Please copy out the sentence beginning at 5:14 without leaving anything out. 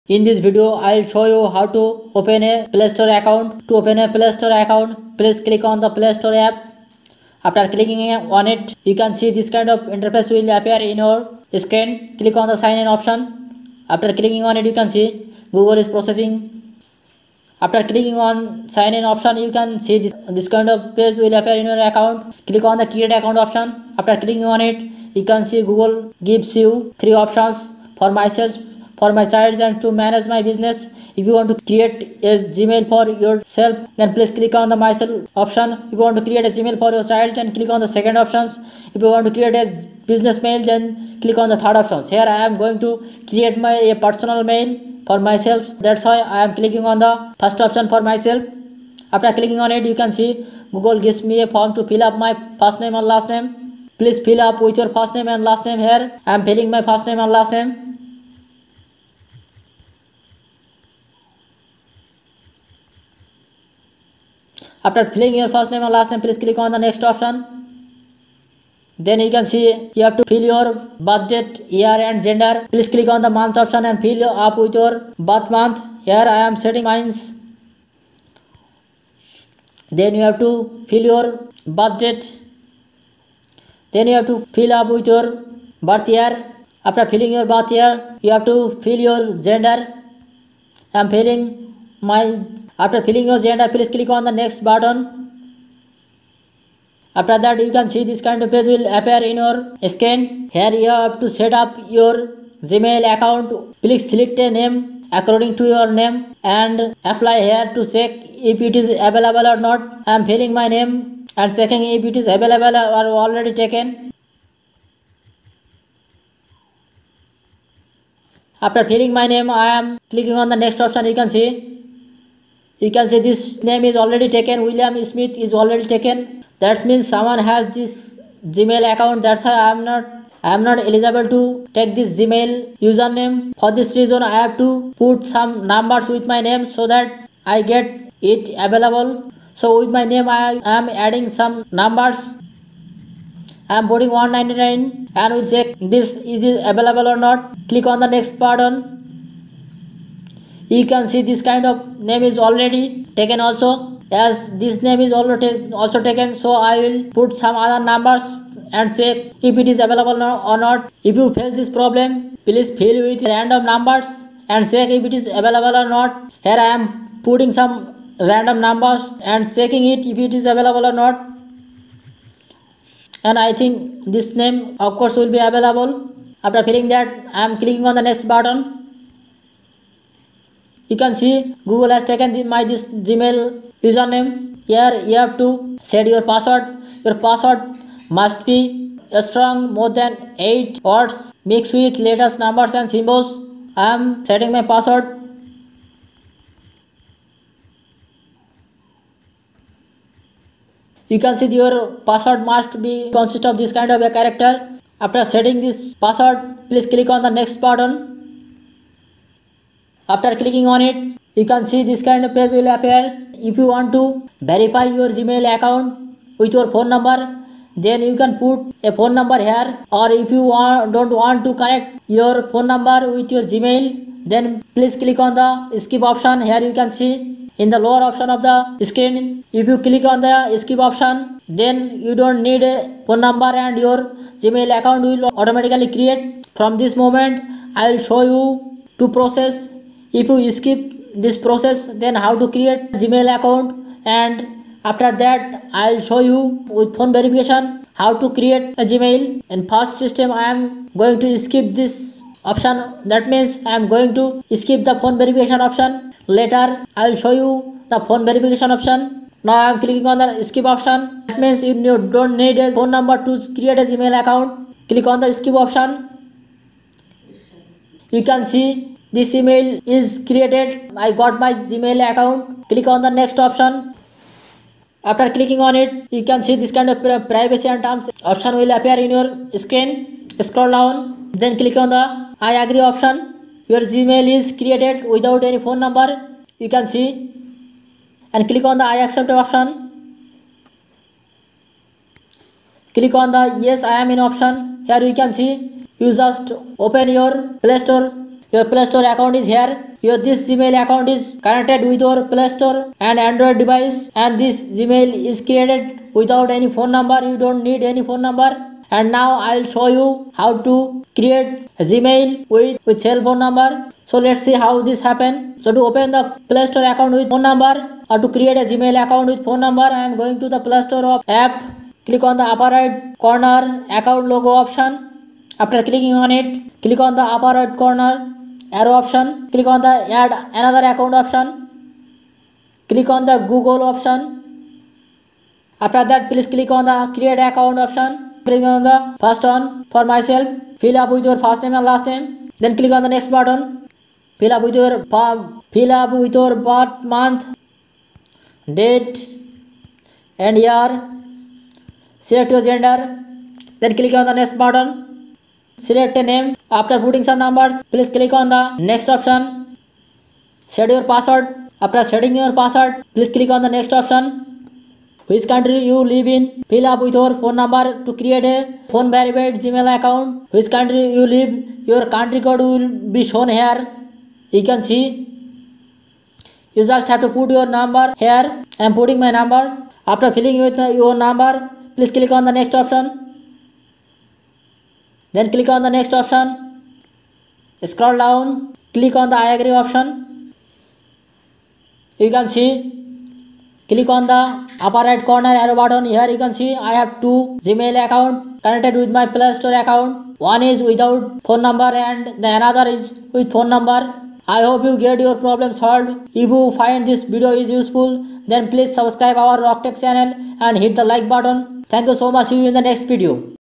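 So let's see how this happen.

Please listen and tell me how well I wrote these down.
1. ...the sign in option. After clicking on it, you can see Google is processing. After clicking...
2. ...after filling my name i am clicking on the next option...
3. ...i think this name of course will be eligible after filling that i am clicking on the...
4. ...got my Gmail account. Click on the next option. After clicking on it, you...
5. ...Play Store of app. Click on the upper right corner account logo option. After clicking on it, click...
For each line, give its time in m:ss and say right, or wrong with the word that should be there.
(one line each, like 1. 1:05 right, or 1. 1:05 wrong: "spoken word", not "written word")
1. 0:12 right
2. 1:58 right
3. 2:53 wrong: "available", not "eligible"
4. 4:31 right
5. 5:20 right.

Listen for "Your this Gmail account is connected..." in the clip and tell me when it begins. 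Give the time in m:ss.
5:00.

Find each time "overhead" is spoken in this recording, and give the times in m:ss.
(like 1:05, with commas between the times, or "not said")
not said.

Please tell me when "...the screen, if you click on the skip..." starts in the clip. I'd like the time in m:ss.
3:48.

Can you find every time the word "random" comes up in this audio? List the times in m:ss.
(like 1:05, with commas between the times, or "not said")
2:43, 2:48.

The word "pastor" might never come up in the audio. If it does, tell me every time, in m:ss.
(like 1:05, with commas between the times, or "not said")
not said.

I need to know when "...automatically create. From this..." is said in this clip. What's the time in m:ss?
3:55.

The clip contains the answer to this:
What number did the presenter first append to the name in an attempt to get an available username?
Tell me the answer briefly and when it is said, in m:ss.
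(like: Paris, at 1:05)
199, at 2:24.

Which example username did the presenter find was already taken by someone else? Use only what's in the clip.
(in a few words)
William Smith.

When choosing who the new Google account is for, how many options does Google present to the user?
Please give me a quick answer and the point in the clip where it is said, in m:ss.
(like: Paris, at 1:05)
3, at 0:26.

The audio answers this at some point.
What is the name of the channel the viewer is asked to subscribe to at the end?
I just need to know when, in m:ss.
6:49.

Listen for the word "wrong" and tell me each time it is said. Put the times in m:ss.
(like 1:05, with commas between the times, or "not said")
not said.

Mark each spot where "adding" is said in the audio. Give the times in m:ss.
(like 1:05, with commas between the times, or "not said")
2:20.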